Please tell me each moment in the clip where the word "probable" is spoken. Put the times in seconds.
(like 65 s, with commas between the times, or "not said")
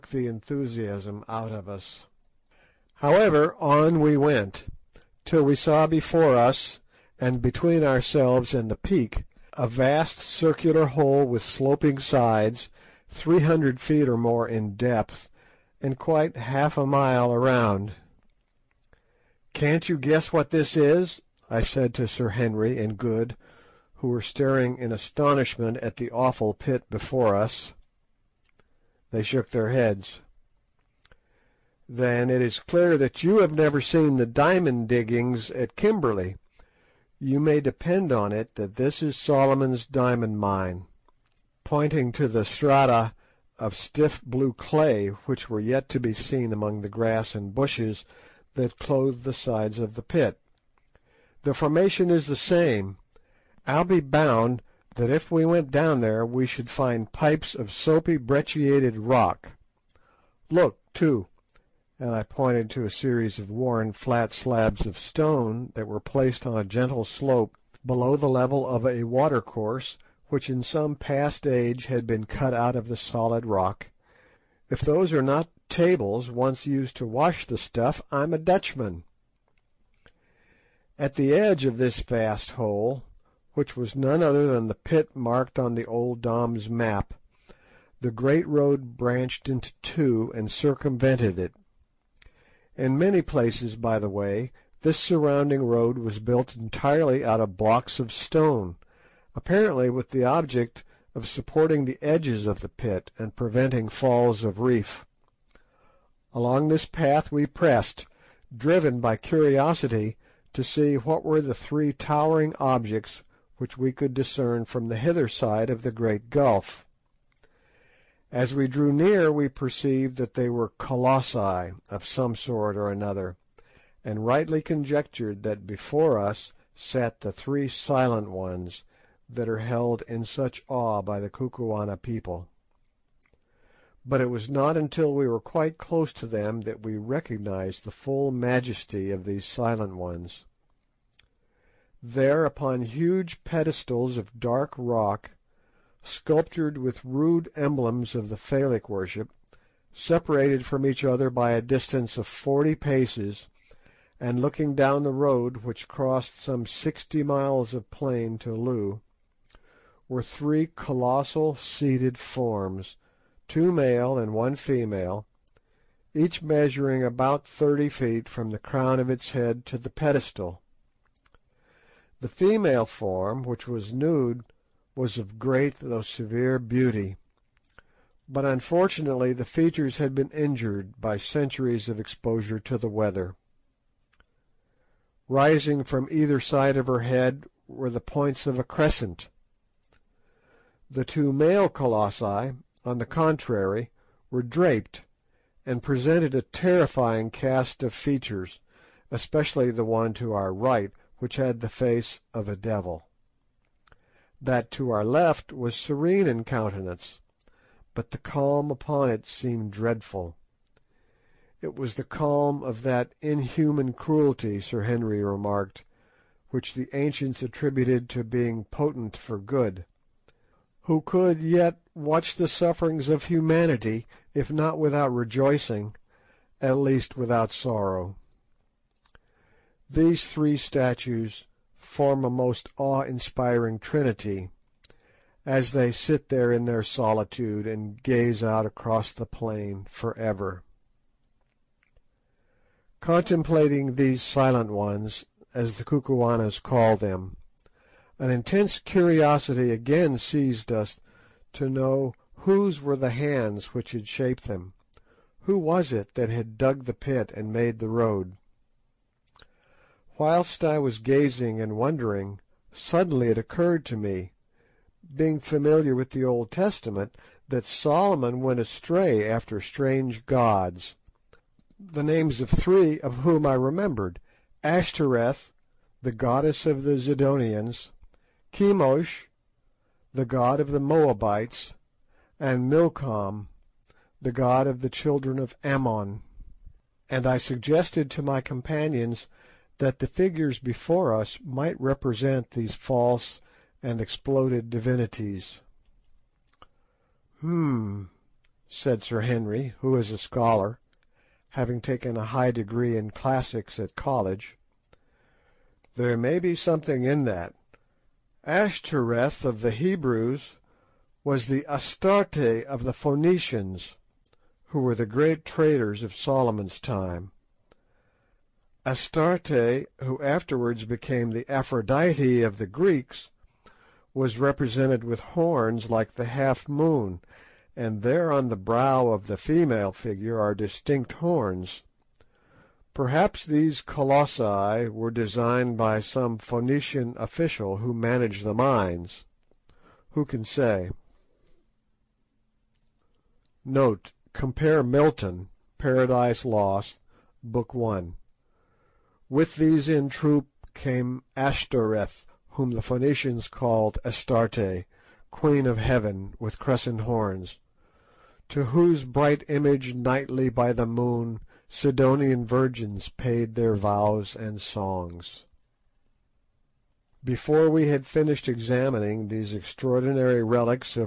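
not said.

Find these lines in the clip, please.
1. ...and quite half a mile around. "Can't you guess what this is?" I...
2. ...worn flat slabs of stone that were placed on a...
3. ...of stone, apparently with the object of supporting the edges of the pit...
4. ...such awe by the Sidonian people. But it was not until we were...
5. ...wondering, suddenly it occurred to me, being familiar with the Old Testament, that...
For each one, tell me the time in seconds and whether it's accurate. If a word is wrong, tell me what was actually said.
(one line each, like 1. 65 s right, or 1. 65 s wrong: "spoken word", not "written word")
1. 15 s right
2. 63 s right
3. 97 s right
4. 130 s wrong: "Kukuana", not "Sidonian"
5. 261 s right.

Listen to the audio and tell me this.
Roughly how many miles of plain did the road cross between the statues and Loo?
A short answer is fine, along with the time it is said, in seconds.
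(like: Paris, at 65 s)
60, at 156 s.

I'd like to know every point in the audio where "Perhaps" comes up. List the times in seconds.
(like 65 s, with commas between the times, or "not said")
332 s.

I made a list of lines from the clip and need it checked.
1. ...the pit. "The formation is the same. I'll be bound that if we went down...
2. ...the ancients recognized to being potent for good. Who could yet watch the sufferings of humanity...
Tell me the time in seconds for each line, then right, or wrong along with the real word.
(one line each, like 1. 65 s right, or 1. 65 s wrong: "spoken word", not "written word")
1. 49 s right
2. 216 s wrong: "attributed", not "recognized".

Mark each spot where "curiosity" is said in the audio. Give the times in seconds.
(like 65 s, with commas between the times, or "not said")
109 s, 248 s.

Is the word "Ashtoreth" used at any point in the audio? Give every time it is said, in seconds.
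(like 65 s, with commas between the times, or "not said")
274 s, 308 s, 351 s.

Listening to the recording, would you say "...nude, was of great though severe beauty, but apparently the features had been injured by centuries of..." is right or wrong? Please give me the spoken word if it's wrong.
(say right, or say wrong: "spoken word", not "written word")
wrong: "unfortunately", not "apparently".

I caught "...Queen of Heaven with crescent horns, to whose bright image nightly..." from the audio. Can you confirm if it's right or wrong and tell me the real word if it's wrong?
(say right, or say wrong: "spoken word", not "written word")
right.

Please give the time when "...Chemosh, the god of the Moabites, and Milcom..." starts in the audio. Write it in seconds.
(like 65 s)
278 s.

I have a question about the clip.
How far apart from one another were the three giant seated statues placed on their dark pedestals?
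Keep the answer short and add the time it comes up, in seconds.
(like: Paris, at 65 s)
forty paces, at 152 s.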